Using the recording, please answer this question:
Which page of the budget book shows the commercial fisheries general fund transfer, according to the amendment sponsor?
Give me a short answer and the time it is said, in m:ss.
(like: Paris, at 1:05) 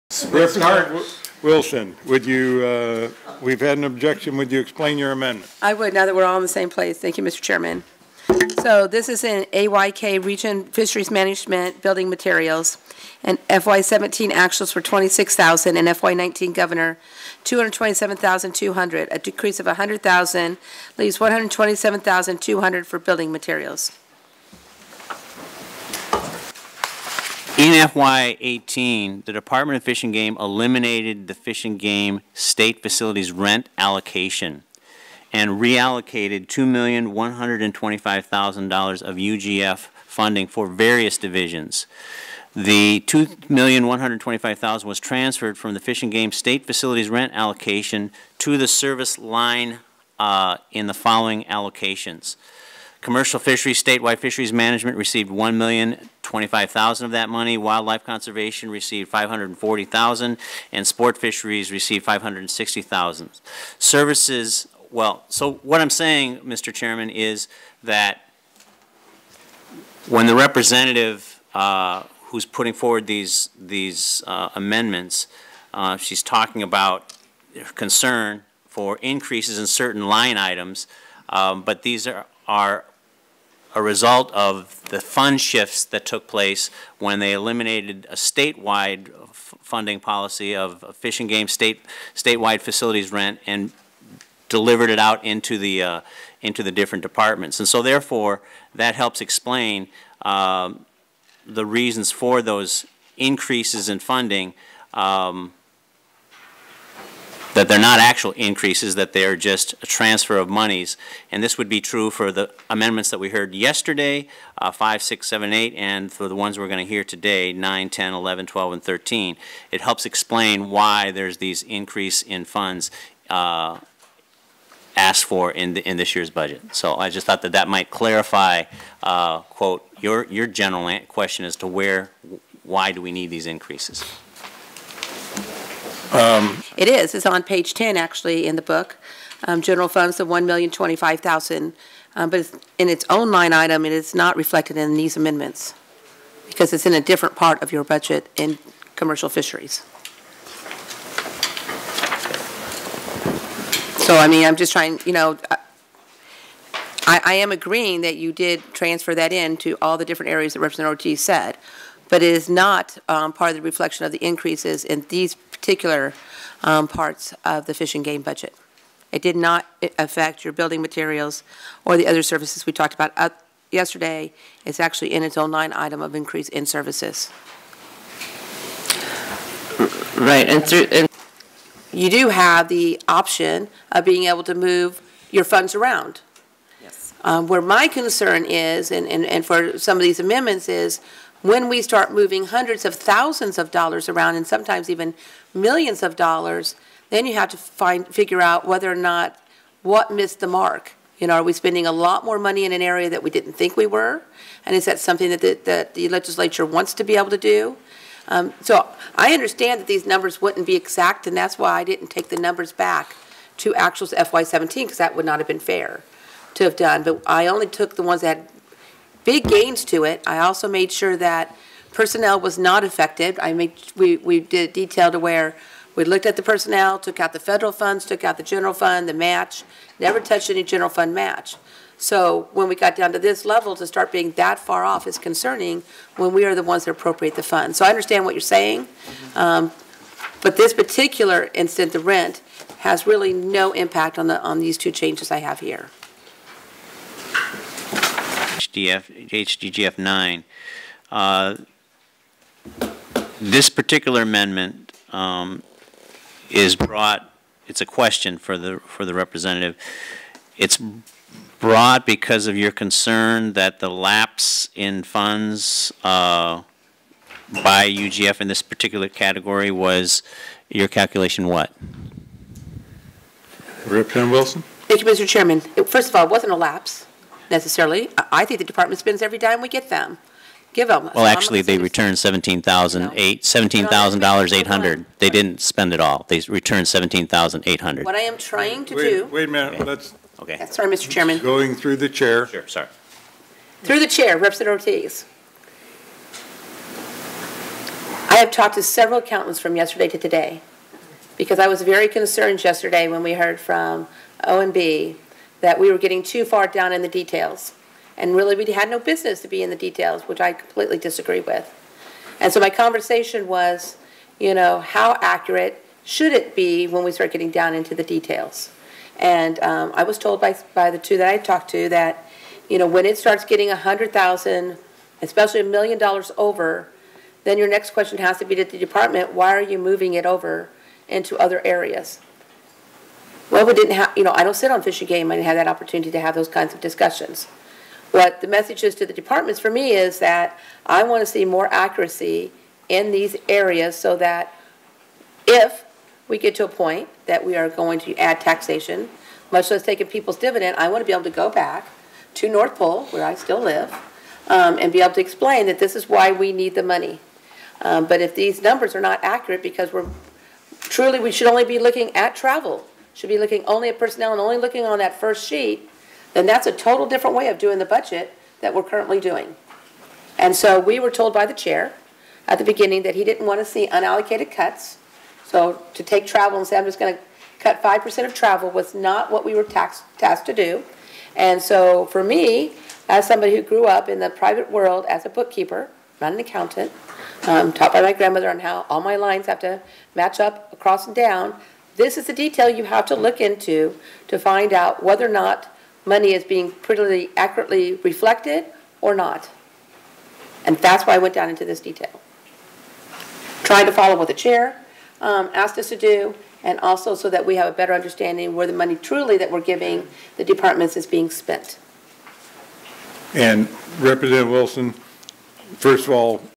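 Page 10, at 2:17.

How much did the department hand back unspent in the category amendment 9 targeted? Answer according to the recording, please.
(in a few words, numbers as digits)
$17,800.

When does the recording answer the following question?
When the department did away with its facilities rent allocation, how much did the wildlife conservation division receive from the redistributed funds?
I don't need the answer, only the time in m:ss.
0:59.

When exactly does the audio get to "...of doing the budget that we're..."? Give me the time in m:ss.
6:07.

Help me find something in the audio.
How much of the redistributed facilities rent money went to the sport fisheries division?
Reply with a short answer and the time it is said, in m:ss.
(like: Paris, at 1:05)
560,000, at 1:02.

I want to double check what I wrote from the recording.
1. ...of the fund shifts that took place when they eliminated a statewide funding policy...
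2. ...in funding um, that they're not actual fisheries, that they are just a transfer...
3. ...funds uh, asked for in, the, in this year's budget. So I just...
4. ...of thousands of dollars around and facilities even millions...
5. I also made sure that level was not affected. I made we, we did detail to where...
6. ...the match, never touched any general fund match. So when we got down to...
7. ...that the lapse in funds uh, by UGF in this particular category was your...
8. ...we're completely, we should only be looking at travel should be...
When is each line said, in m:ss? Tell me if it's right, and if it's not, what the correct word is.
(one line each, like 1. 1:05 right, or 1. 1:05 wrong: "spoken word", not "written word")
1. 1:24 right
2. 1:43 wrong: "increases", not "fisheries"
3. 2:02 right
4. 3:12 wrong: "sometimes", not "facilities"
5. 3:40 wrong: "personnel", not "level"
6. 3:49 right
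7. 4:23 right
8. 5:59 wrong: "truly", not "completely".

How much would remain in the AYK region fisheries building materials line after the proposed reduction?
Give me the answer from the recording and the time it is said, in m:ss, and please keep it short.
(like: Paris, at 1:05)
127,200, at 0:21.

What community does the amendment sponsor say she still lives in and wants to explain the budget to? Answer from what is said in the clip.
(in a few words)
North Pole.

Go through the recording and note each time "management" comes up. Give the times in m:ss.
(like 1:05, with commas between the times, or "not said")
0:11, 0:54.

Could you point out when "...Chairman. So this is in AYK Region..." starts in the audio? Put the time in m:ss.
0:07.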